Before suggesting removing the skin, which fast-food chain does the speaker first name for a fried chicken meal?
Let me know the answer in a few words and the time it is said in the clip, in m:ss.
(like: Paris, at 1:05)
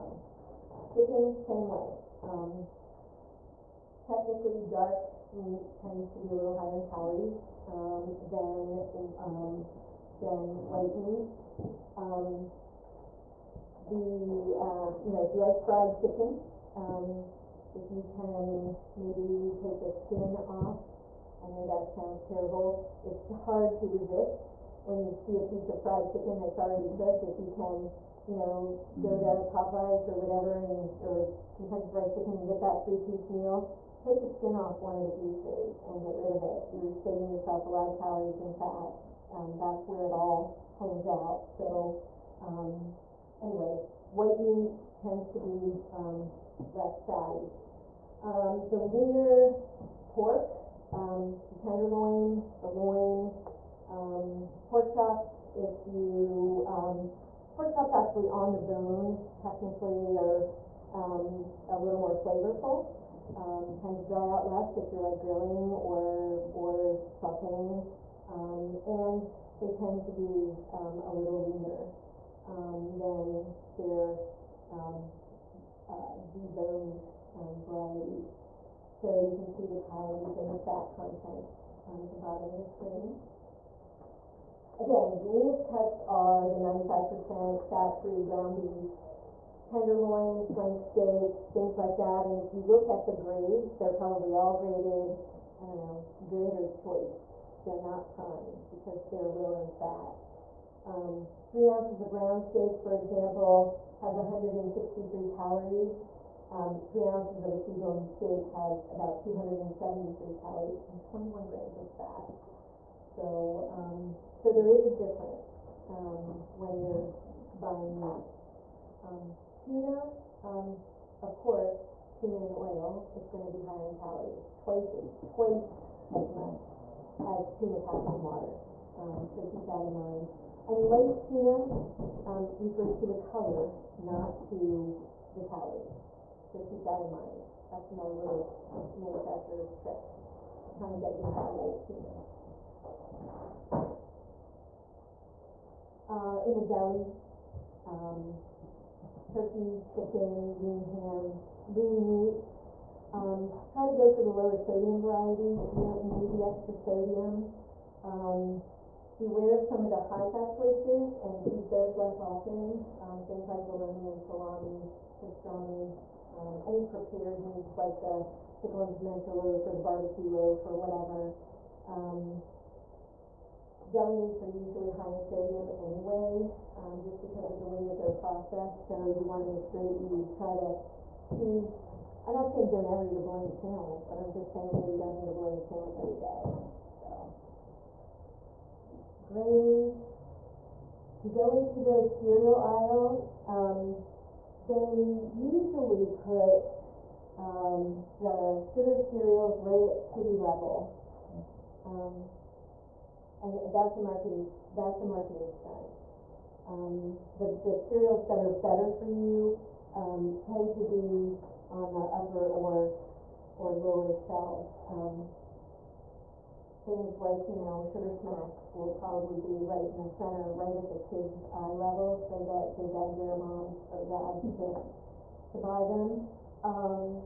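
Popeyes, at 0:29.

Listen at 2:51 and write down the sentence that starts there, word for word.
Um, deli meats are usually high in sodium anyway, um, just because of the way that they're processed.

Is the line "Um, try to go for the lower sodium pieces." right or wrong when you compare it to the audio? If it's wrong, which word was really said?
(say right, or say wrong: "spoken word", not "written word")
wrong: "varieties", not "pieces".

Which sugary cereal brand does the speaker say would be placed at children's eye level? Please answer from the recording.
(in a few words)
Sugar Smacks.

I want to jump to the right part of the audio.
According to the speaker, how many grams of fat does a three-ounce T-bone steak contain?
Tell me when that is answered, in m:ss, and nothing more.
1:51.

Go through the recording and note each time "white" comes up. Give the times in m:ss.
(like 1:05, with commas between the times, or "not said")
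0:10, 0:44.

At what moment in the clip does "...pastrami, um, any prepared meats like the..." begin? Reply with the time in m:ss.
2:45.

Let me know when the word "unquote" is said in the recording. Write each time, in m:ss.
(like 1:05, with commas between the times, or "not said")
not said.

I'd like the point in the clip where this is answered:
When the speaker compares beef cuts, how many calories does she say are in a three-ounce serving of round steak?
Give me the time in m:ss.
1:44.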